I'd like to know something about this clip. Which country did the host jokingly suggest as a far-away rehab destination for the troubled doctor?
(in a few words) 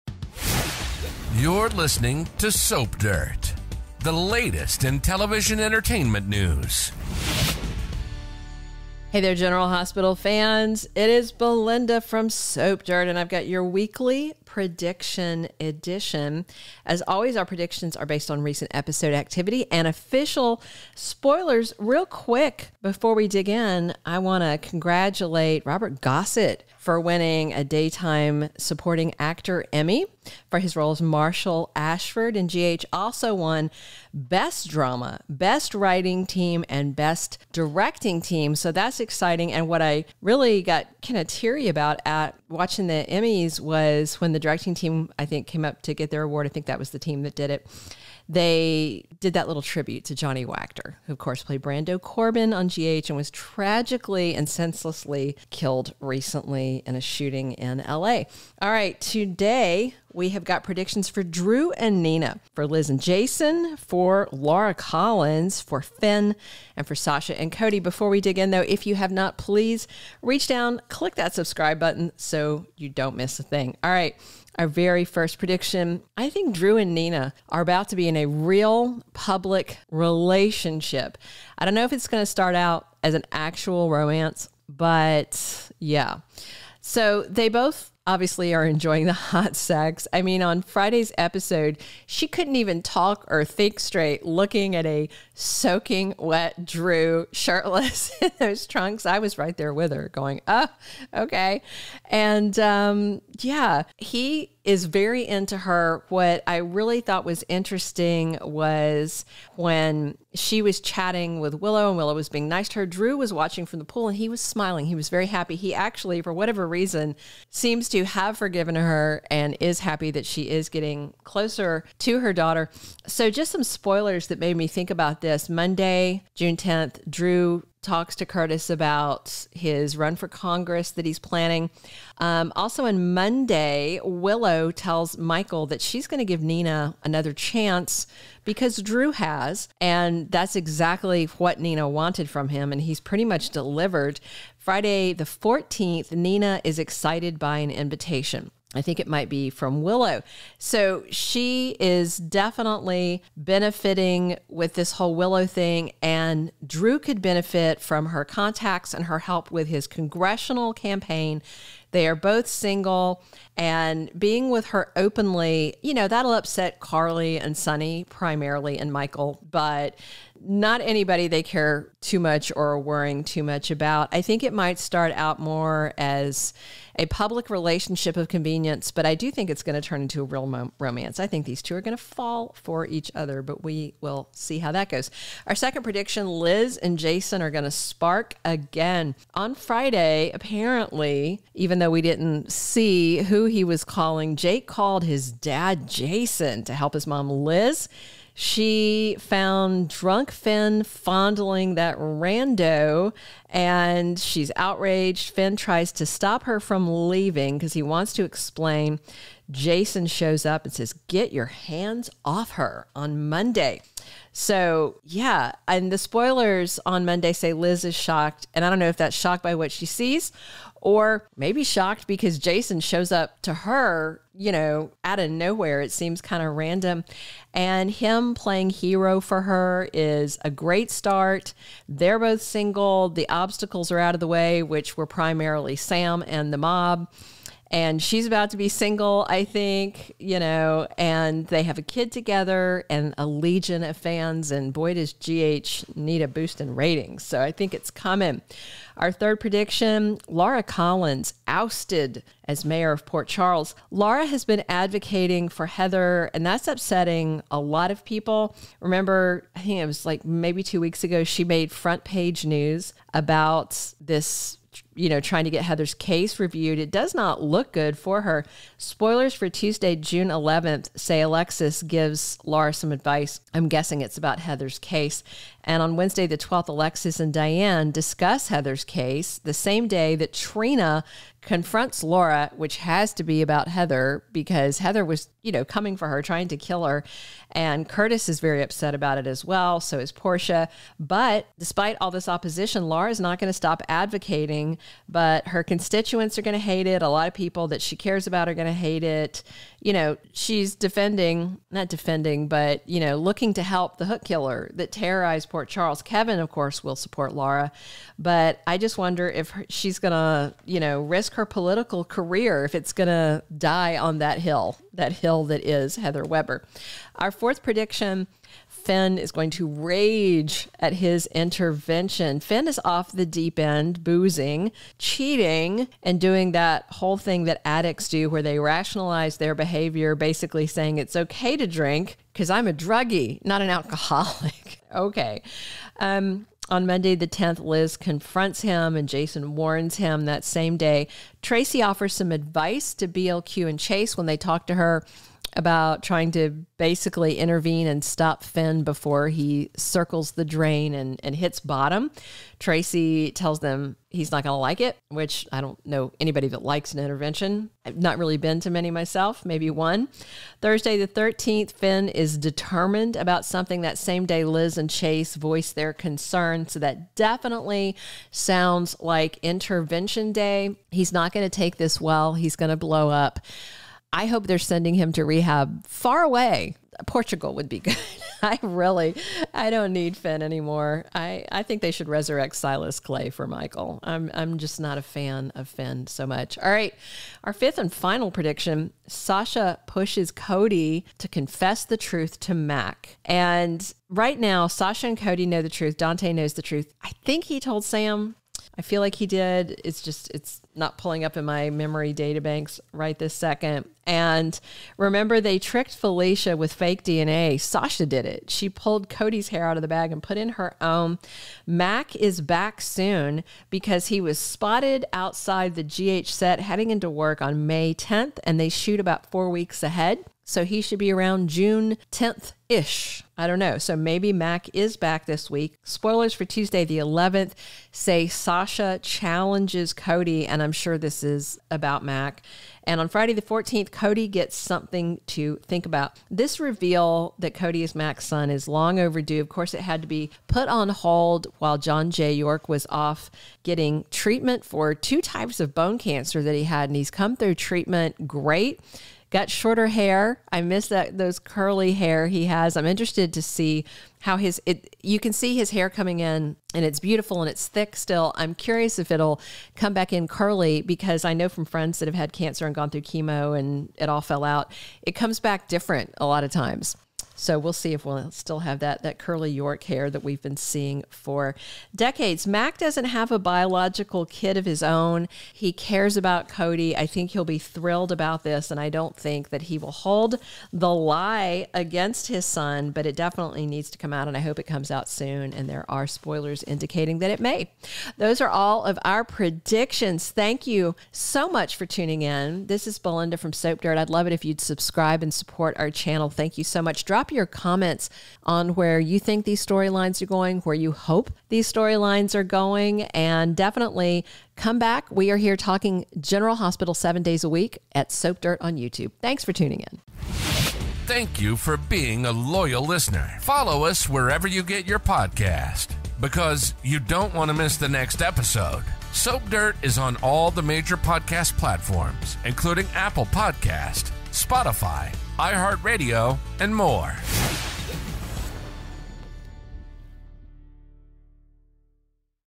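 Portugal.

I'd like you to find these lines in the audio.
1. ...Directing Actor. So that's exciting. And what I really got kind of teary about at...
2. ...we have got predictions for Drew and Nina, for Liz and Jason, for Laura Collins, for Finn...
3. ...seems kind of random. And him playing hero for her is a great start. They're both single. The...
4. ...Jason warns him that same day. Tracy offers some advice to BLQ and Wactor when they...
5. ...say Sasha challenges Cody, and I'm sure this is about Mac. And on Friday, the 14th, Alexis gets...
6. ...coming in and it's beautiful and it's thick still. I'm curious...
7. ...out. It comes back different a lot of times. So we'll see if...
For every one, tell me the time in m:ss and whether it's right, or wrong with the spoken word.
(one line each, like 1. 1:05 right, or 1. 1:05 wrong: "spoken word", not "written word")
1. 0:37 wrong: "Team", not "Actor"
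2. 1:00 right
3. 3:45 right
4. 5:39 wrong: "Chase", not "Wactor"
5. 7:07 wrong: "Cody", not "Alexis"
6. 7:35 right
7. 7:44 right.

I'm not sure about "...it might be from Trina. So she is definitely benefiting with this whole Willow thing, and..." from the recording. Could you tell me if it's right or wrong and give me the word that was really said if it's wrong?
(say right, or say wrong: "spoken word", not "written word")
wrong: "Willow", not "Trina".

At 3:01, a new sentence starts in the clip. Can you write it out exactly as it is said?
I think these two are going to fall for each other, but we will see how that goes.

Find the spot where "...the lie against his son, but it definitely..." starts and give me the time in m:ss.
8:00.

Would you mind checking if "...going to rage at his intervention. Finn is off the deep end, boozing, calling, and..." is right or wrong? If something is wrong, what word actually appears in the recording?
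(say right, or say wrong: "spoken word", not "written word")
wrong: "cheating", not "calling".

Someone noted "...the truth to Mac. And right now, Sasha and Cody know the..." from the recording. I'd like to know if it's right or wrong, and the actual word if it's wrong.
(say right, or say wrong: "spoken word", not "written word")
right.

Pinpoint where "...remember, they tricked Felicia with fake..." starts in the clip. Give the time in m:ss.
6:44.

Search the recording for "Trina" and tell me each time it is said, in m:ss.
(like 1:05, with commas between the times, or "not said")
4:40.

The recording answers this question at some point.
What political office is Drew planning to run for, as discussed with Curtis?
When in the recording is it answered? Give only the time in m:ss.
2:10.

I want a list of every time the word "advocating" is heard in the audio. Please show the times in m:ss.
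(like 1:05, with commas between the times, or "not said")
4:14, 4:53.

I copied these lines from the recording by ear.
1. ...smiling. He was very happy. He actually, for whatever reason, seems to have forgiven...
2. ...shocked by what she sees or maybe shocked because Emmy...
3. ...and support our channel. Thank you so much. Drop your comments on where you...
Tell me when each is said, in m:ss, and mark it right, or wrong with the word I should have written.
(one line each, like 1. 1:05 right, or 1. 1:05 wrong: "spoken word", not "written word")
1. 1:54 right
2. 3:39 wrong: "Jason", not "Emmy"
3. 8:15 right.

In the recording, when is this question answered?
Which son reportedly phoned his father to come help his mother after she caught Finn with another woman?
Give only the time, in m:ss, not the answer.
3:14.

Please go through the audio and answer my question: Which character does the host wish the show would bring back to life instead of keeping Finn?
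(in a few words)
Silas Clay.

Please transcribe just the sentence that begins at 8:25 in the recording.
We are here talking General Hospital seven days a week at Soap Dirt on YouTube.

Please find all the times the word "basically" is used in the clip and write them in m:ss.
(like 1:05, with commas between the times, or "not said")
5:30, 5:46.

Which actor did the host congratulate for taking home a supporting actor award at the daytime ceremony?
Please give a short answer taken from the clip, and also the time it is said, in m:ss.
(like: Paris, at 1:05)
Robert Gossett, at 0:25.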